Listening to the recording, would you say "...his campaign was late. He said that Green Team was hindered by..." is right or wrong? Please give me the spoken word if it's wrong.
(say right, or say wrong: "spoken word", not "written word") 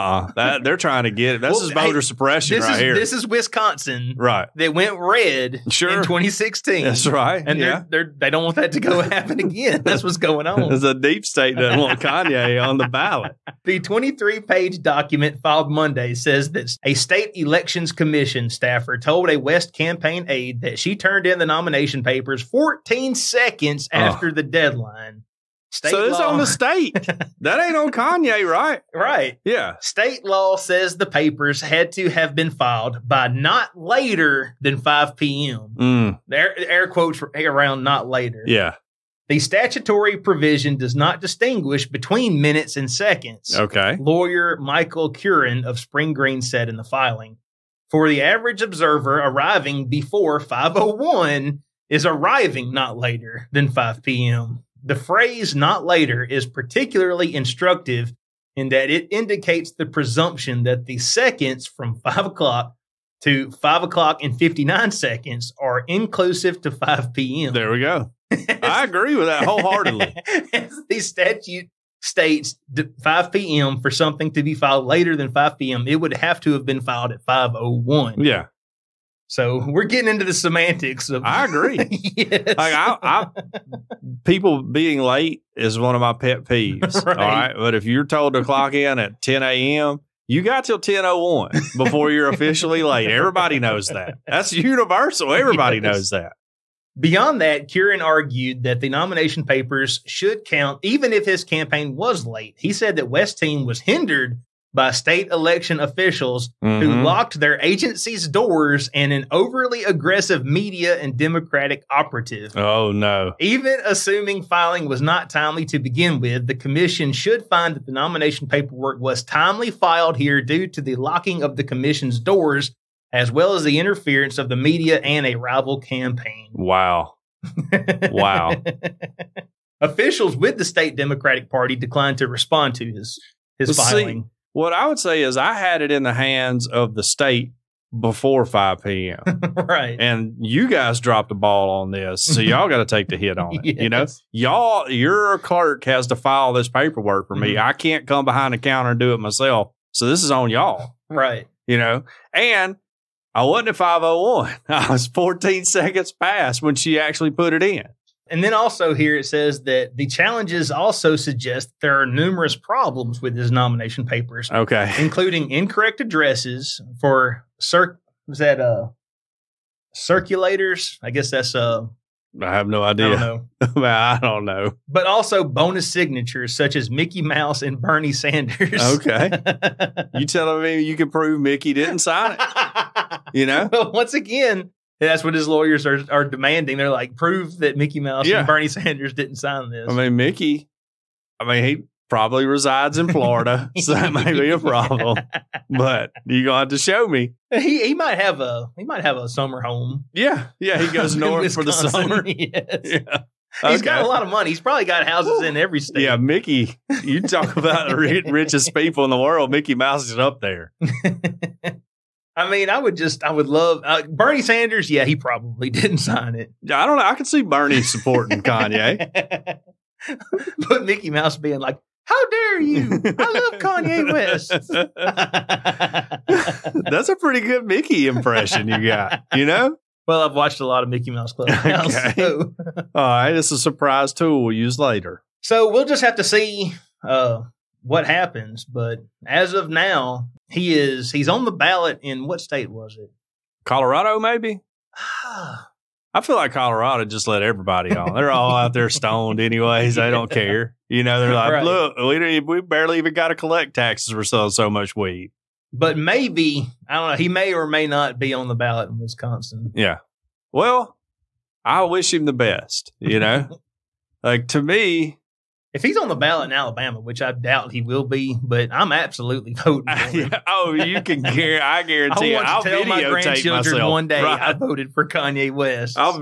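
wrong: "West", not "Green".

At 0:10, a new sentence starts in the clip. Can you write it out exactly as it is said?
a deep state that want Kanye on the ballot.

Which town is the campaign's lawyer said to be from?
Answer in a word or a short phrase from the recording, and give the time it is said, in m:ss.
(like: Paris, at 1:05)
Spring Green, at 0:45.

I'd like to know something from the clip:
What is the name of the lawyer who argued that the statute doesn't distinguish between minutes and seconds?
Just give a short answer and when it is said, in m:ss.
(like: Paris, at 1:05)
Michael Curran, at 0:44.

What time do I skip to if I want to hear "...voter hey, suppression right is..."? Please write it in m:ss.
0:01.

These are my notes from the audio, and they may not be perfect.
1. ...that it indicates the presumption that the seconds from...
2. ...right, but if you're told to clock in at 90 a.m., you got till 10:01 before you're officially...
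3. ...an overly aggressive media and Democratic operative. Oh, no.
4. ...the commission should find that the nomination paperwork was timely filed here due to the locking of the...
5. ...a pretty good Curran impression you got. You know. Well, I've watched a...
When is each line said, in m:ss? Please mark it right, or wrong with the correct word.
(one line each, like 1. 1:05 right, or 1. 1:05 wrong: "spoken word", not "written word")
1. 0:58 right
2. 1:27 wrong: "10", not "90"
3. 1:49 right
4. 1:56 right
5. 3:47 wrong: "Mickey", not "Curran".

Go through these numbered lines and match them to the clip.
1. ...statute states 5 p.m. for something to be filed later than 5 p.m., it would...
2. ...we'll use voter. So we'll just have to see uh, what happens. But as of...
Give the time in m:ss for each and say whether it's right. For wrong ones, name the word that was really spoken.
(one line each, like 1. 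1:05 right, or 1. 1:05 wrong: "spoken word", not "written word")
1. 1:11 right
2. 3:54 wrong: "later", not "voter".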